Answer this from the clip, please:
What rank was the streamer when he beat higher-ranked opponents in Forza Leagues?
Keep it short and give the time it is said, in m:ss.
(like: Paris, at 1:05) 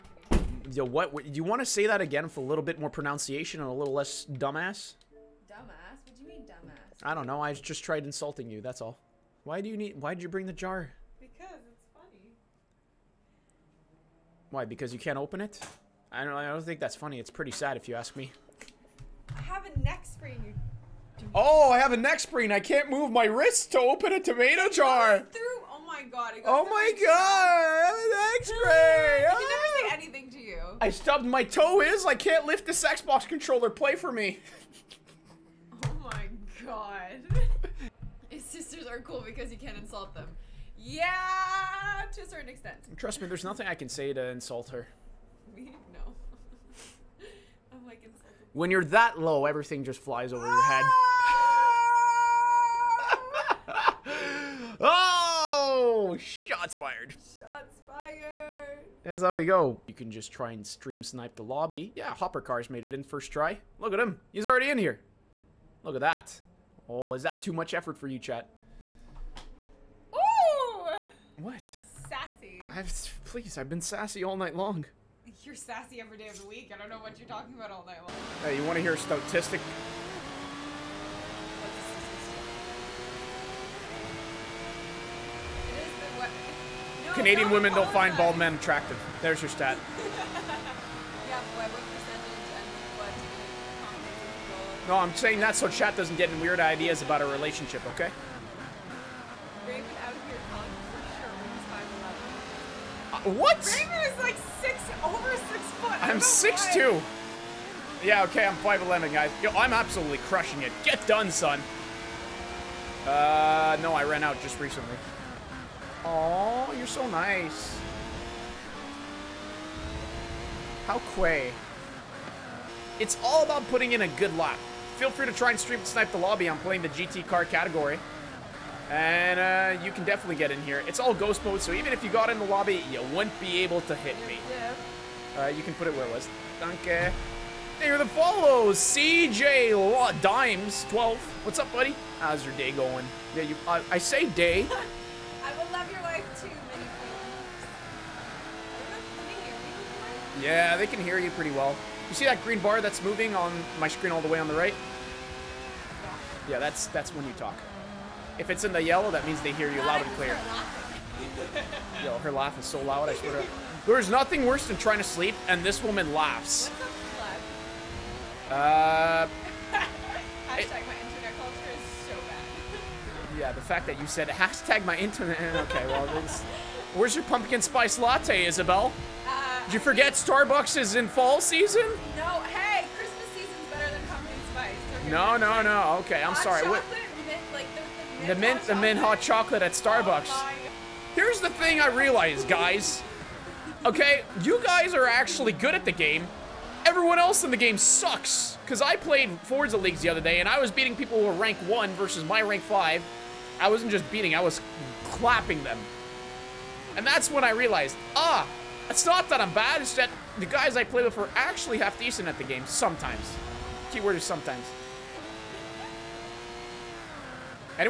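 5, at 3:22.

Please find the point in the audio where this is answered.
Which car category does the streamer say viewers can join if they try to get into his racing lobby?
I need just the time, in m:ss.
2:06.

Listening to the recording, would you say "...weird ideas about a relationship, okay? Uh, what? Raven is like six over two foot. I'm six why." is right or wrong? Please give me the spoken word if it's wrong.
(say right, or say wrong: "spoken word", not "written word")
wrong: "six", not "two".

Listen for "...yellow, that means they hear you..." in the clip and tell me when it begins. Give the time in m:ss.
2:38.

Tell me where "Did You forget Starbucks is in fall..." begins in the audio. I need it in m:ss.
2:59.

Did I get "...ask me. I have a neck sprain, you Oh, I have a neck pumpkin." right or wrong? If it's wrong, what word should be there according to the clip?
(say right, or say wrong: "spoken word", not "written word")
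wrong: "sprain", not "pumpkin".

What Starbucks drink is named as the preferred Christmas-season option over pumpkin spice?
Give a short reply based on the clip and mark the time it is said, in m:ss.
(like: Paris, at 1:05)
mint hot chocolate, at 3:08.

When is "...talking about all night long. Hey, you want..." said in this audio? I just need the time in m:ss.
1:17.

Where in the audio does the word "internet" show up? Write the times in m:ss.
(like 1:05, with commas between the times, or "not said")
2:50, 2:54.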